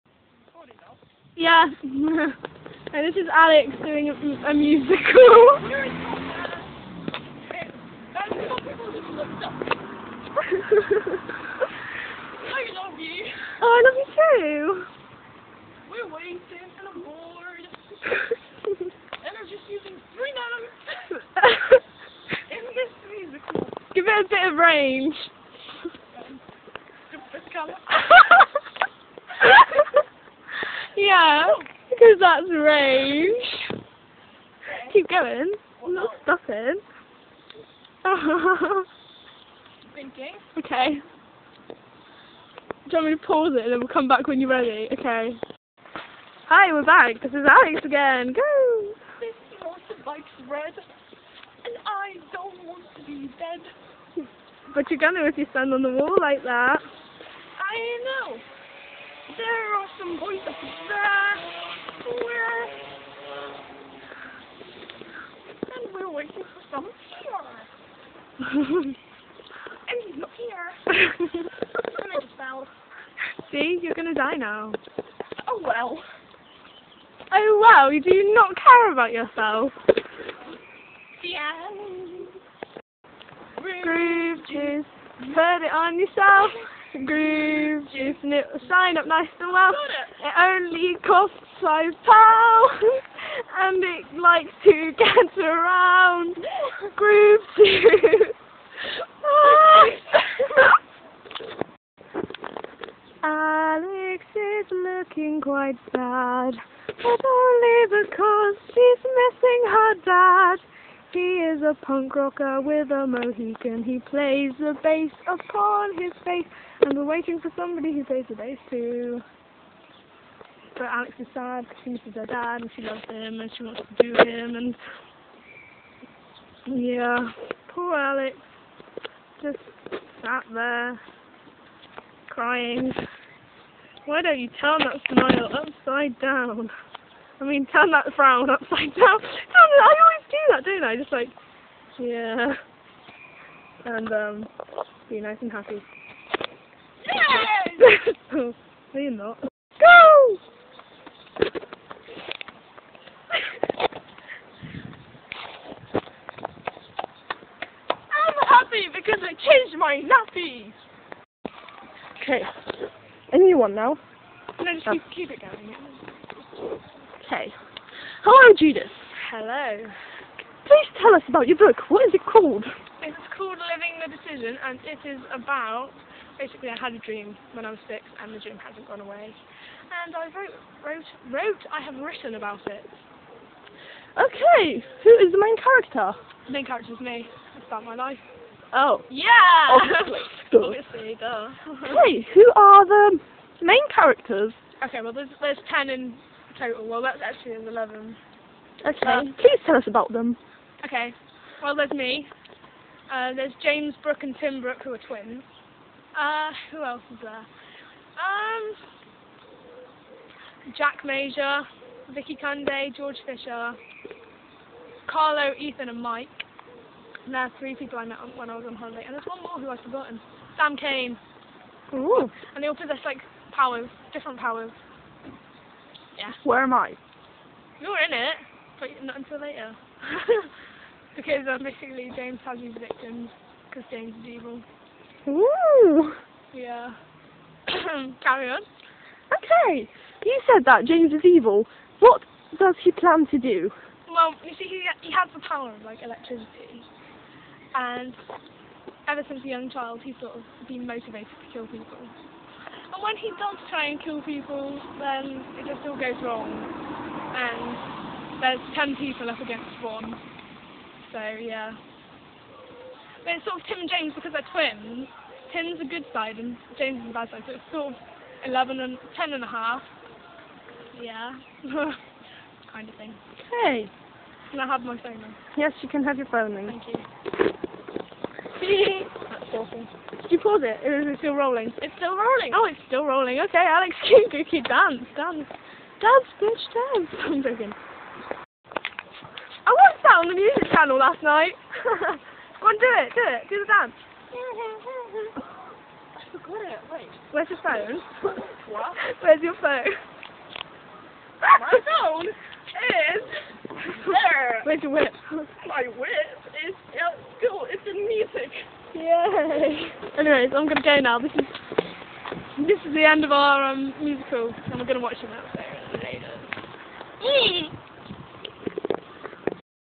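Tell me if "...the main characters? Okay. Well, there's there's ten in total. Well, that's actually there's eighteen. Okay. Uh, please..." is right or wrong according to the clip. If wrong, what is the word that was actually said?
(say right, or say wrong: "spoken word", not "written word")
wrong: "eleven", not "eighteen".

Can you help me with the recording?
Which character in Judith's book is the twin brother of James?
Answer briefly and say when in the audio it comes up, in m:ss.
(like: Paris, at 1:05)
Tim Brook, at 3:24.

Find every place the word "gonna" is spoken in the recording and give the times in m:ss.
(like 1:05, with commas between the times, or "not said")
0:54, 1:13, 5:10, 5:14.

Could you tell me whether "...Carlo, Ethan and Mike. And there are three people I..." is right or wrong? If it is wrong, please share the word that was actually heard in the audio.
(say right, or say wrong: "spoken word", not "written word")
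right.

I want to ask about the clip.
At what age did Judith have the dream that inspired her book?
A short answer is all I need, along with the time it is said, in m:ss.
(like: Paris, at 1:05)
6, at 2:57.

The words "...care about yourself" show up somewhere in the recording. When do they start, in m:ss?
1:18.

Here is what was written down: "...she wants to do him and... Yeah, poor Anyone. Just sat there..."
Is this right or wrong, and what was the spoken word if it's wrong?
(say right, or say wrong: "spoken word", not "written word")
wrong: "Alex", not "Anyone".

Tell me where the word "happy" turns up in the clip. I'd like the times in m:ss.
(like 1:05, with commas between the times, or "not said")
2:25, 2:38.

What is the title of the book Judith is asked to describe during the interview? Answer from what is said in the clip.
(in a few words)
Living the Decision.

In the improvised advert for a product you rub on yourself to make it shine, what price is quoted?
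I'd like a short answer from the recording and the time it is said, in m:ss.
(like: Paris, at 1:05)
5 pounds, at 1:31.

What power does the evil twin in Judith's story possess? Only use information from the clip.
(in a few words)
electricity.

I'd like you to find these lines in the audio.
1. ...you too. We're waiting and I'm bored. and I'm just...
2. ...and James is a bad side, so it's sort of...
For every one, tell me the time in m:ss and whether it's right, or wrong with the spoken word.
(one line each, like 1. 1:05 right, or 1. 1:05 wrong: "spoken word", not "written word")
1. 0:13 right
2. 4:26 right.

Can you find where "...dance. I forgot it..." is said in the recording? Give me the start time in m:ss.
4:53.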